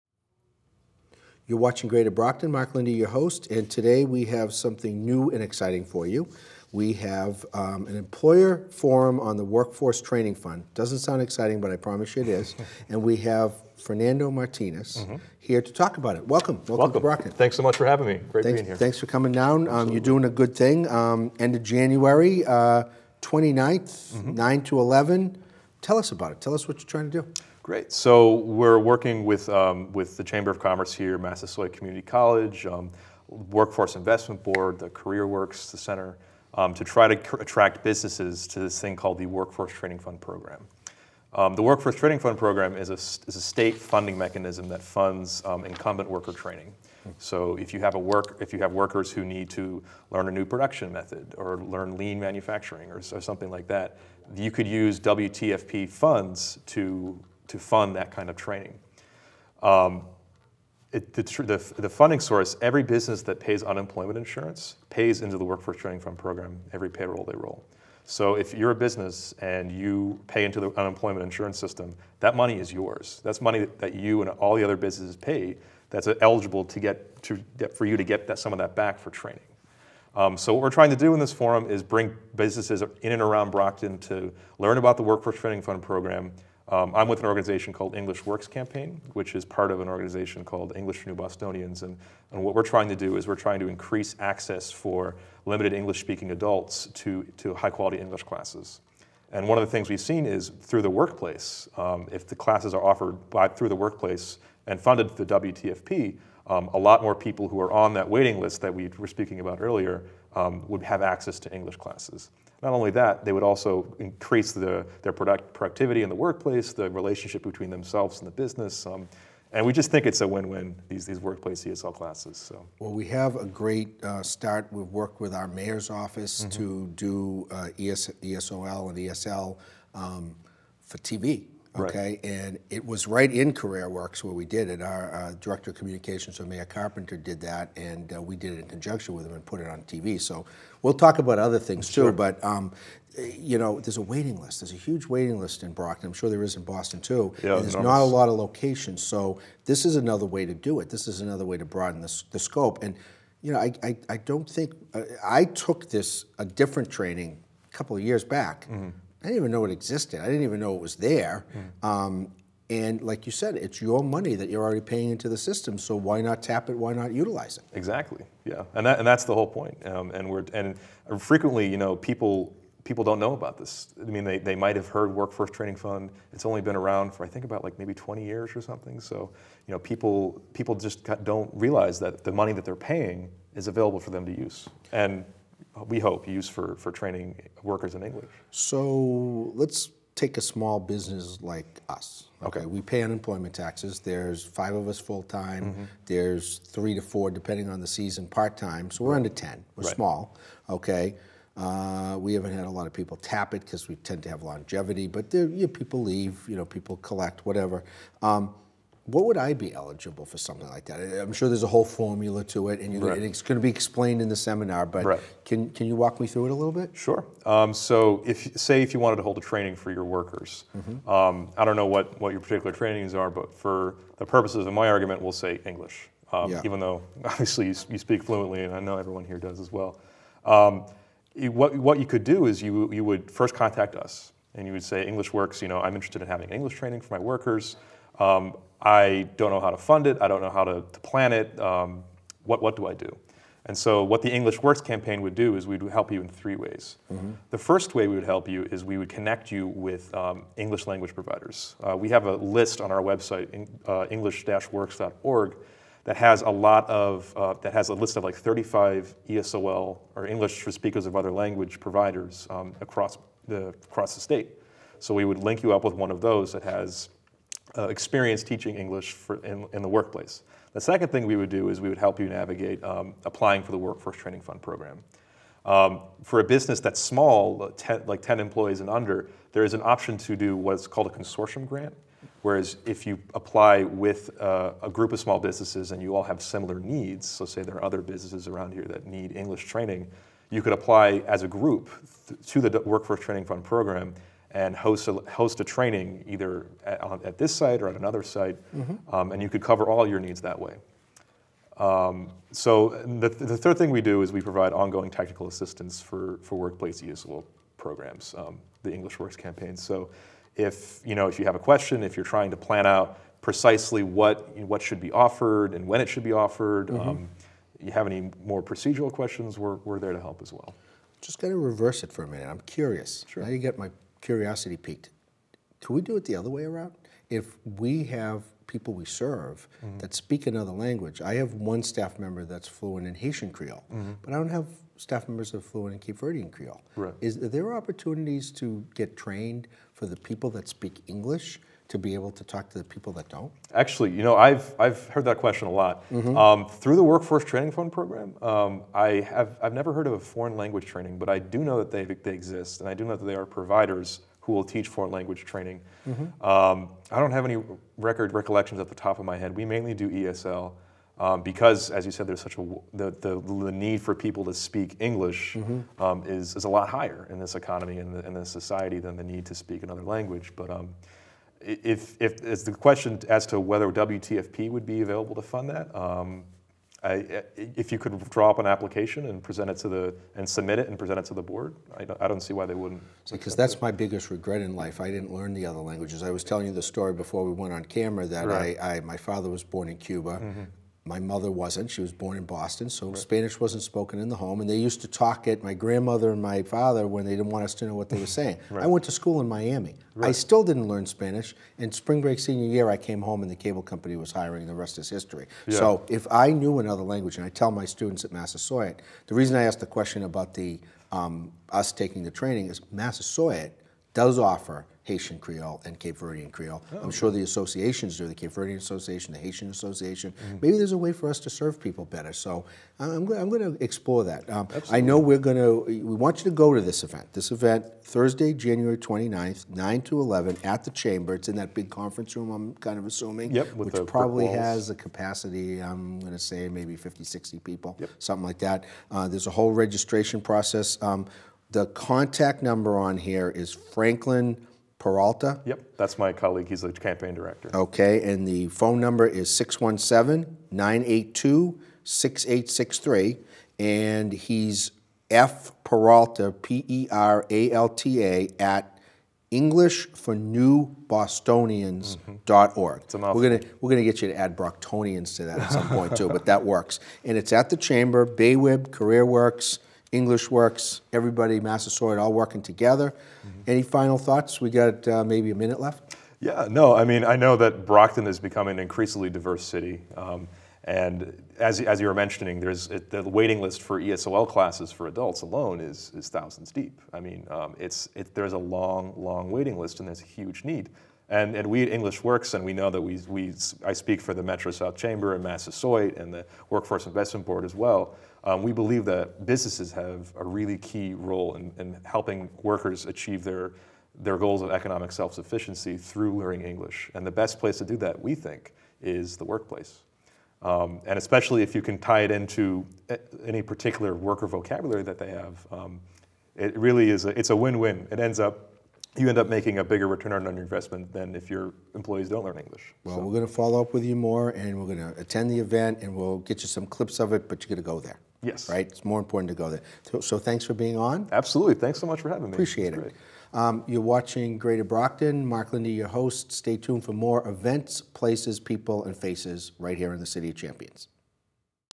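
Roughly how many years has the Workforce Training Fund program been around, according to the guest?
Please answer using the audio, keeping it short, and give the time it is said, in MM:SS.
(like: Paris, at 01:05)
20 years, at 02:57.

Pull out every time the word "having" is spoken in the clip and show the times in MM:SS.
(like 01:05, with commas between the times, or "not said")
00:17, 03:56, 08:52.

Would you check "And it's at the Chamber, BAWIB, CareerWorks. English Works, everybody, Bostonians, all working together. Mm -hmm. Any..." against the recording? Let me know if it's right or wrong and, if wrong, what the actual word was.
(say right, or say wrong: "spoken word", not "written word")
wrong: "Massasoit", not "Bostonians".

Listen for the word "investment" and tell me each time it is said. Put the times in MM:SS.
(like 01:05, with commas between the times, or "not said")
00:33, 08:17, 08:40.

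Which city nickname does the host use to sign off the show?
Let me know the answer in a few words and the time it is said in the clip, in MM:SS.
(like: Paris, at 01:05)
City of Champions, at 09:00.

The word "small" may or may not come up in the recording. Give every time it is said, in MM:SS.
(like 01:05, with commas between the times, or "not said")
03:10, 03:19, 04:36, 04:45.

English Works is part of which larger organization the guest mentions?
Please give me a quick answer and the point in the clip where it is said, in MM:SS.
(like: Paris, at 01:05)
English for New Bostonians, at 01:30.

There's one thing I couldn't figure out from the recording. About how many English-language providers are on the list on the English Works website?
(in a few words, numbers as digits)
35.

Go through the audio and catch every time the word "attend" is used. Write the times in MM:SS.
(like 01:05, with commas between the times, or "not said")
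08:45.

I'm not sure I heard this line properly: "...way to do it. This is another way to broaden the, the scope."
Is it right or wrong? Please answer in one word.
right.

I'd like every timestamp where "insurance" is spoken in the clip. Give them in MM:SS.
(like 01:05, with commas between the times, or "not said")
01:04, 01:11.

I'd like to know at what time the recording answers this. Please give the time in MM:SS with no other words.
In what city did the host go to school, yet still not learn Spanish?
06:39.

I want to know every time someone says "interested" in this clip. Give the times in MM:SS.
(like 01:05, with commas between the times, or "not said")
03:55.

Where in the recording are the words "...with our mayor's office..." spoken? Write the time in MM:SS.
02:05.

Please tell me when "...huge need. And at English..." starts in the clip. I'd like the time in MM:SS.
08:10.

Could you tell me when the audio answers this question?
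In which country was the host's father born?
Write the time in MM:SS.
06:29.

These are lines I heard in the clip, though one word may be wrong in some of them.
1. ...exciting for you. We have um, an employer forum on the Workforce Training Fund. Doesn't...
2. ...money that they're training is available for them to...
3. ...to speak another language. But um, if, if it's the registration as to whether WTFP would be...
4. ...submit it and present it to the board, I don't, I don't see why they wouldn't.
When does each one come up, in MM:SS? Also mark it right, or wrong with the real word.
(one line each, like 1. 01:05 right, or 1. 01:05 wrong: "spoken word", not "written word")
1. 00:05 right
2. 03:02 wrong: "paying", not "training"
3. 06:09 wrong: "question", not "registration"
4. 06:20 right.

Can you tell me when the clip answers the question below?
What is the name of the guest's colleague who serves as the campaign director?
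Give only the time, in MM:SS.
07:23.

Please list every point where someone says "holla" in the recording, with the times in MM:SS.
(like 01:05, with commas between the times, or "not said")
not said.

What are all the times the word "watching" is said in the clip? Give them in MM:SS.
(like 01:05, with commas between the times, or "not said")
00:01, 08:54.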